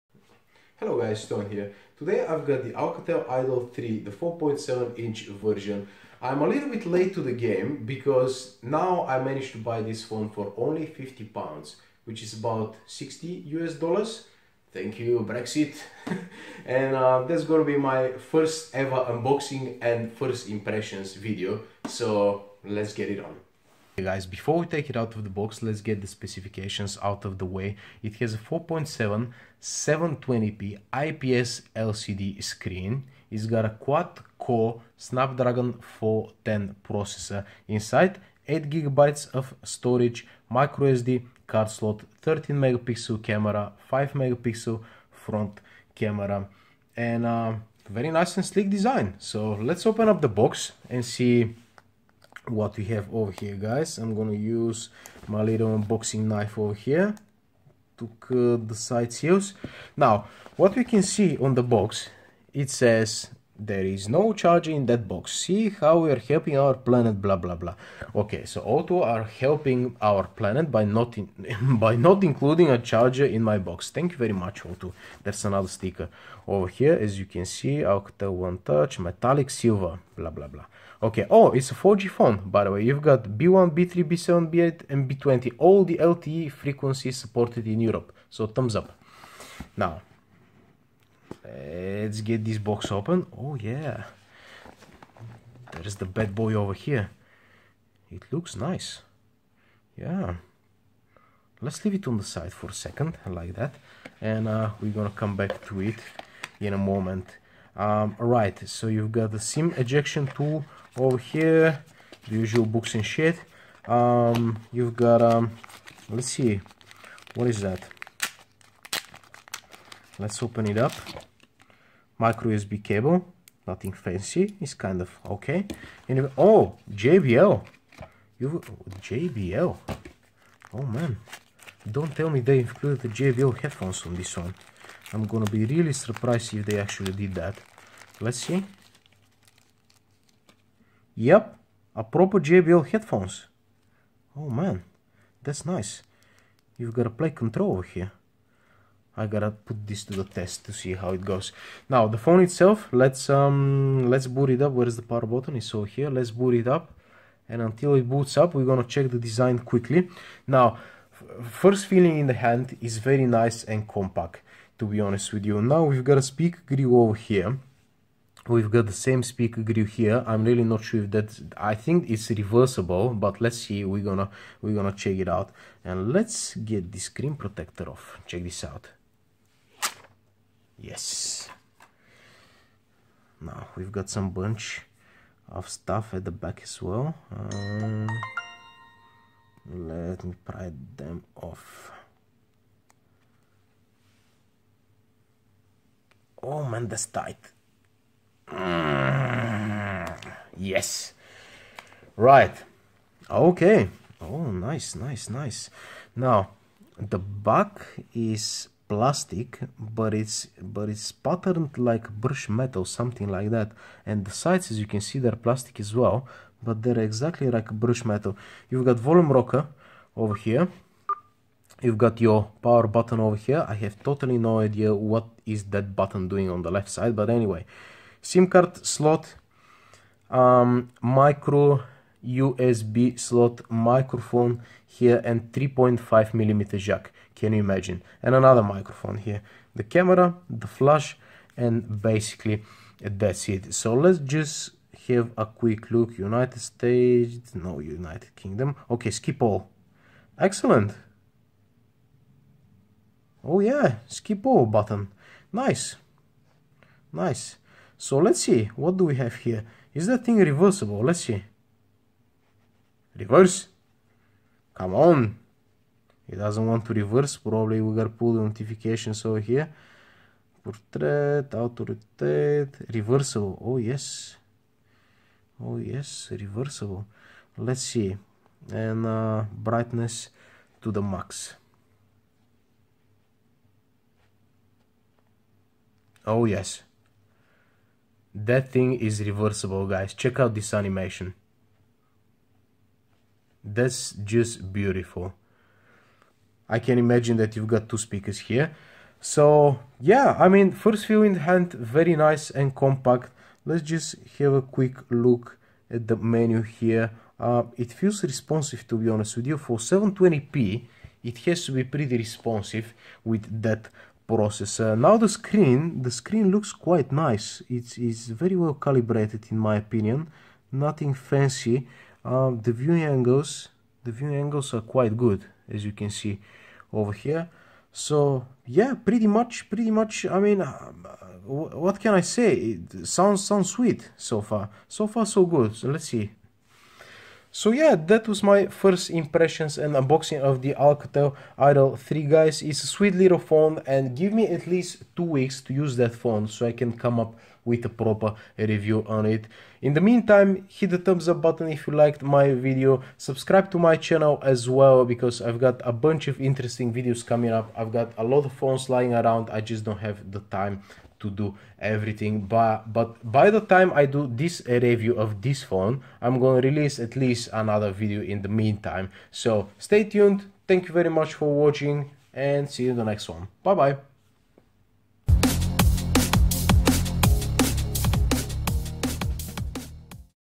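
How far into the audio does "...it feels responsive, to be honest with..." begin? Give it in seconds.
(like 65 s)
307 s.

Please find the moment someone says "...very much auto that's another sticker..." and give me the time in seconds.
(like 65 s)
74 s.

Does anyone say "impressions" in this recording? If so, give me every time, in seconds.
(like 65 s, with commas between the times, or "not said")
20 s, 339 s.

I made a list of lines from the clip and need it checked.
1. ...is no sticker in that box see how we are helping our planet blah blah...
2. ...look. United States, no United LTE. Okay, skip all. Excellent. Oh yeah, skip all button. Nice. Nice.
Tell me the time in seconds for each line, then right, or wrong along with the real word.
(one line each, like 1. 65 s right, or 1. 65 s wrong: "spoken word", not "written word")
1. 63 s wrong: "charger", not "sticker"
2. 245 s wrong: "Kingdom", not "LTE".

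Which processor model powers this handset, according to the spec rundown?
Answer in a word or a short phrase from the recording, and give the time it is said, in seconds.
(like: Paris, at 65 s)
Snapdragon 410, at 34 s.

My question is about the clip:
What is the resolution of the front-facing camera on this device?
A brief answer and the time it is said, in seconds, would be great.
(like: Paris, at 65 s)
5 megapixel, at 43 s.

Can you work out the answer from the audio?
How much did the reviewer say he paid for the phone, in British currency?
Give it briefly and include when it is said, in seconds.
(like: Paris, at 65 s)
50 pounds, at 10 s.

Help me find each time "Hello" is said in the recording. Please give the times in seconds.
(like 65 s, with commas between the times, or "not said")
0 s.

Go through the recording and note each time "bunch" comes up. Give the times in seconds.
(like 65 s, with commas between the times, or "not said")
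184 s, 355 s.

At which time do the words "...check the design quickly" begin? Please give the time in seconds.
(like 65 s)
158 s.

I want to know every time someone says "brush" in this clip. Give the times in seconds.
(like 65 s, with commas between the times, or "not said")
212 s, 217 s.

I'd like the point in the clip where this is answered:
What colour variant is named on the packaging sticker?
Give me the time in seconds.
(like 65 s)
78 s.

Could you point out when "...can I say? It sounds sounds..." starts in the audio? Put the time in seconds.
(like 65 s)
331 s.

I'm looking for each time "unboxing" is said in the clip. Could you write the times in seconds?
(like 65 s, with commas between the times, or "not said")
19 s, 55 s, 339 s.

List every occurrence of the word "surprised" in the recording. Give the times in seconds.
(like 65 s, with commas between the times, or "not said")
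135 s.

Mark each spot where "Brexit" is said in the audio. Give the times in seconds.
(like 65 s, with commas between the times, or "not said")
15 s.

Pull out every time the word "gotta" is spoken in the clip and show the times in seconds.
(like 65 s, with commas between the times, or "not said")
149 s, 267 s.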